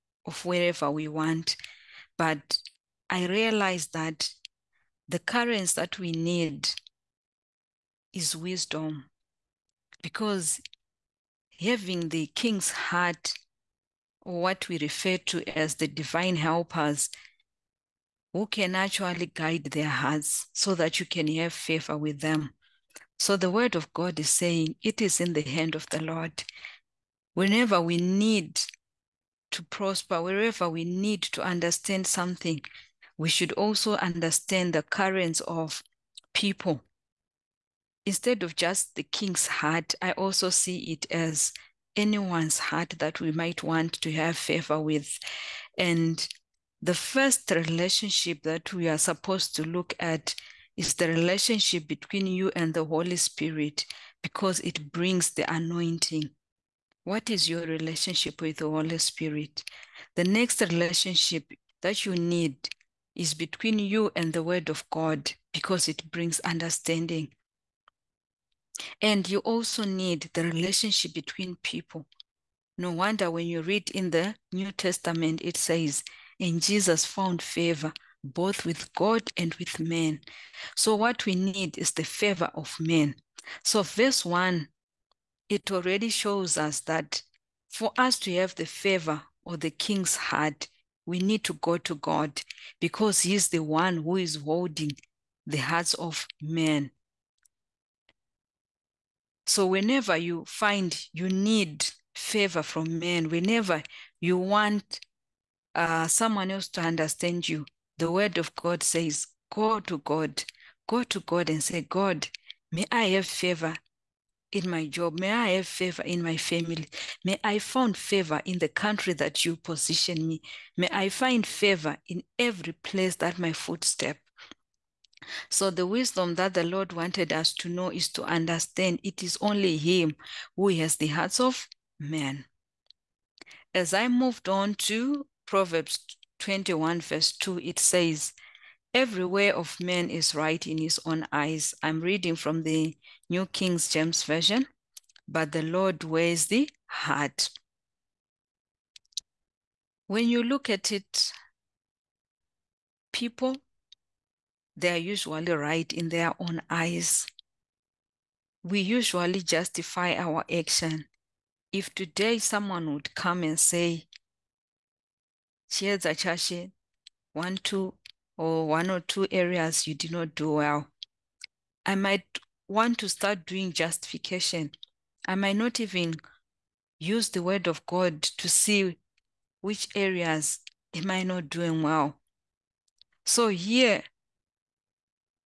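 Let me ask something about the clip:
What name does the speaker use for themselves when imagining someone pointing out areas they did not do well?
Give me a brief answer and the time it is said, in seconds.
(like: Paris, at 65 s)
Achashi, at 166 s.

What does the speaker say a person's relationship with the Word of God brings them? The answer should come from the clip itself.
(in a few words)
Understanding.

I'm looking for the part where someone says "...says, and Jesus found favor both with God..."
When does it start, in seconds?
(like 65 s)
75 s.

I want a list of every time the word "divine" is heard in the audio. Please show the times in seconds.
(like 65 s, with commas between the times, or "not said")
15 s.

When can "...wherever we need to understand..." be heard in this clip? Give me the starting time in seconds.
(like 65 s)
30 s.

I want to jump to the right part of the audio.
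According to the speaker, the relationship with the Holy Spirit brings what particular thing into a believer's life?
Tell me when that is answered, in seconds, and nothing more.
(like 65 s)
55 s.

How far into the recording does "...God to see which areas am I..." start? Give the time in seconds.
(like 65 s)
177 s.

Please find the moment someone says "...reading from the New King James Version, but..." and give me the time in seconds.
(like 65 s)
142 s.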